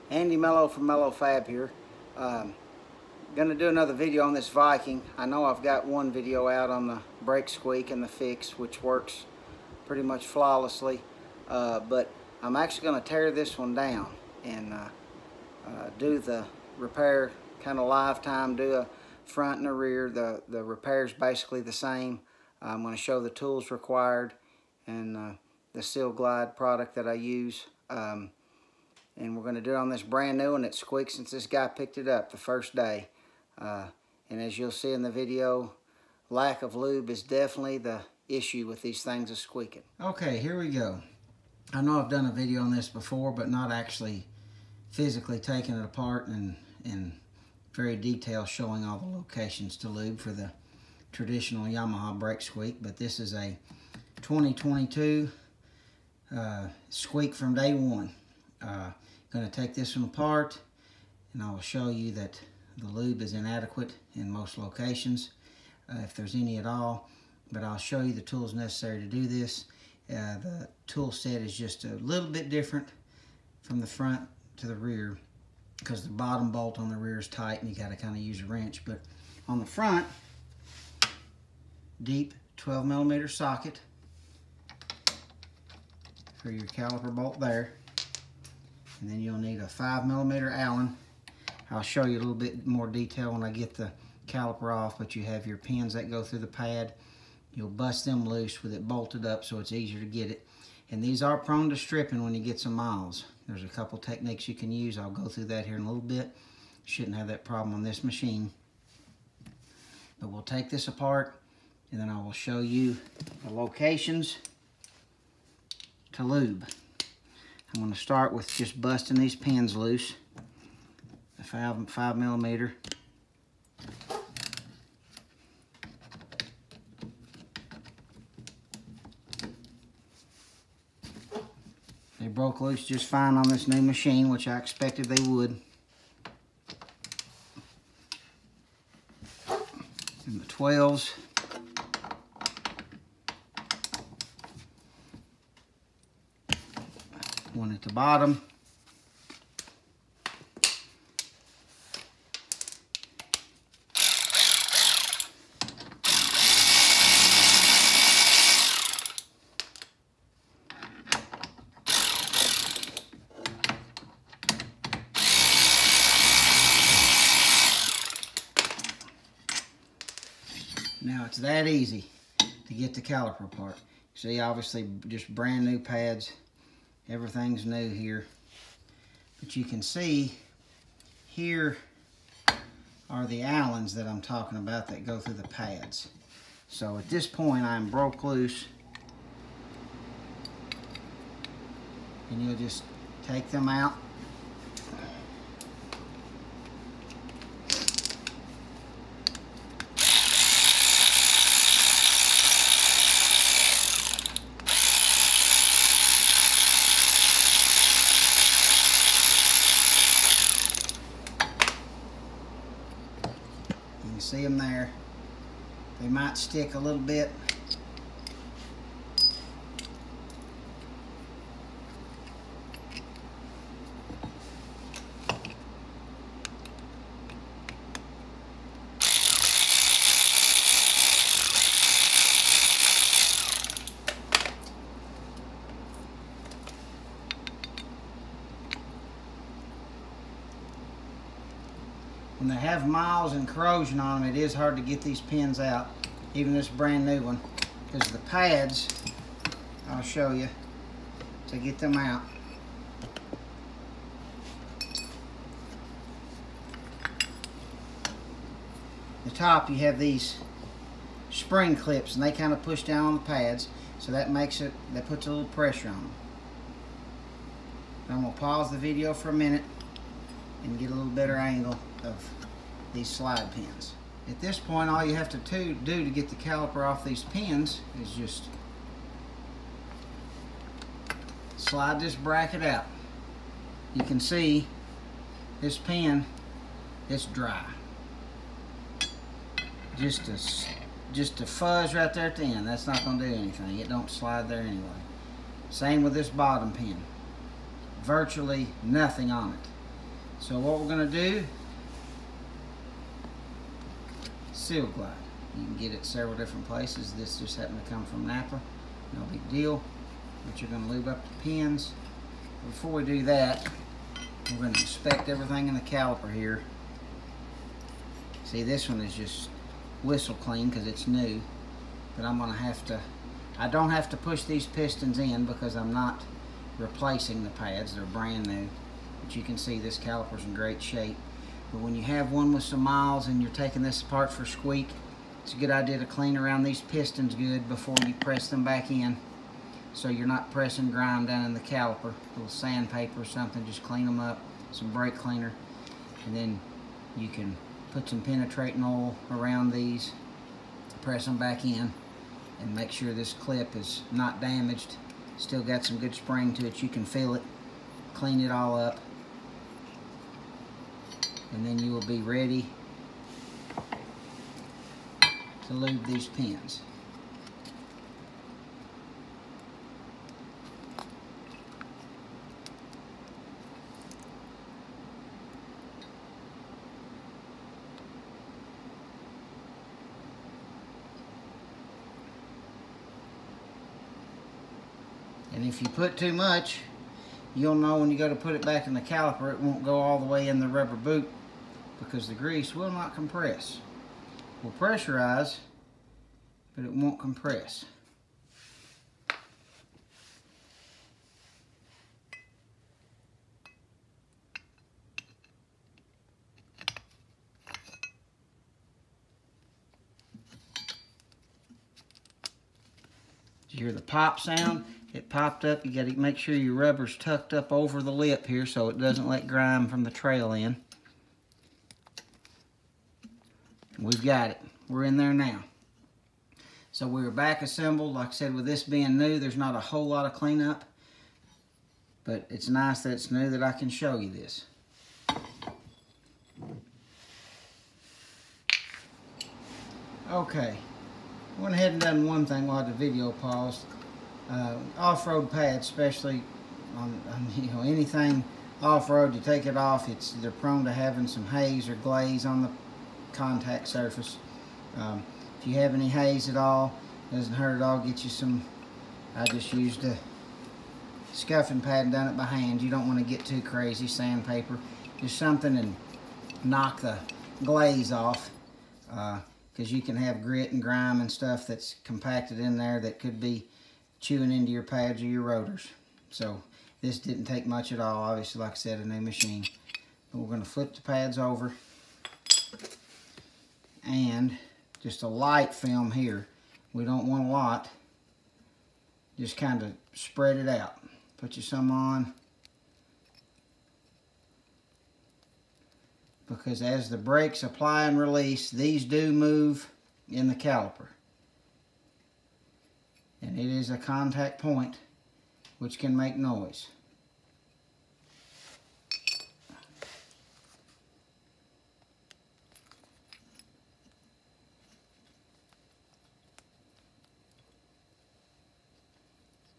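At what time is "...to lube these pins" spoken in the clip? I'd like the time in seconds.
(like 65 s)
365 s.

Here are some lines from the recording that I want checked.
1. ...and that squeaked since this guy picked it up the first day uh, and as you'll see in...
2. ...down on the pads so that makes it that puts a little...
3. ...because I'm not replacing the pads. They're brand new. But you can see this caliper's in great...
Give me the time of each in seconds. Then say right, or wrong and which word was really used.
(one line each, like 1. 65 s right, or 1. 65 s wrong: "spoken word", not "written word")
1. 30 s right
2. 262 s right
3. 325 s right.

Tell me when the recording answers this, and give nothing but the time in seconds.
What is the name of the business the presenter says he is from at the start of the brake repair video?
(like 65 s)
0 s.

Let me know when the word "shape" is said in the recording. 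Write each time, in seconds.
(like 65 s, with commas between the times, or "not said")
330 s.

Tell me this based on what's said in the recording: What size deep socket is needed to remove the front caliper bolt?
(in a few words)
12 millimeter.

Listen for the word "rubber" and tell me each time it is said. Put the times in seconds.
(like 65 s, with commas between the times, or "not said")
390 s, 416 s.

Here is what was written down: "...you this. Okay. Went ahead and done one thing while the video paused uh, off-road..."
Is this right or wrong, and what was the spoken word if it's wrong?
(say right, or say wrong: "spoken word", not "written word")
right.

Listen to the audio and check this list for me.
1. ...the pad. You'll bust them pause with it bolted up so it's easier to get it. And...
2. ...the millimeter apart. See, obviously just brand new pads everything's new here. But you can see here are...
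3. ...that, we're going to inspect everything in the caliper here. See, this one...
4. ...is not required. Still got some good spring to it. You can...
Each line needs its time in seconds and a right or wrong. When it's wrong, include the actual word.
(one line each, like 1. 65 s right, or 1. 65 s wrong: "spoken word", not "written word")
1. 96 s wrong: "loose", not "pause"
2. 172 s wrong: "caliper", not "millimeter"
3. 313 s right
4. 353 s wrong: "damaged", not "required".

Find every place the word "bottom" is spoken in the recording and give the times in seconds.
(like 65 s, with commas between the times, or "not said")
76 s, 147 s, 296 s.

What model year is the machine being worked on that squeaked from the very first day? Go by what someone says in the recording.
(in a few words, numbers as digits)
2022.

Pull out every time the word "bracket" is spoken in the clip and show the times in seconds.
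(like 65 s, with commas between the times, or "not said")
282 s.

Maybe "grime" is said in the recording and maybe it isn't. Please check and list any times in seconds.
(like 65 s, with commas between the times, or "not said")
340 s, 419 s, 470 s.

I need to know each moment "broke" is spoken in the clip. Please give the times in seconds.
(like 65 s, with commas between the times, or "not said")
132 s, 187 s.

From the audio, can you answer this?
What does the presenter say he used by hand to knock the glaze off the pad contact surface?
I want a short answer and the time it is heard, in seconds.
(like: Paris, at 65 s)
a scuffing pad, at 461 s.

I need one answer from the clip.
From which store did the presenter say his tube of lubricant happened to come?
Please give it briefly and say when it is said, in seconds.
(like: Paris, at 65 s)
Napa, at 308 s.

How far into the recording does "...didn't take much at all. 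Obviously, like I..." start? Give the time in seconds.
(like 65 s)
477 s.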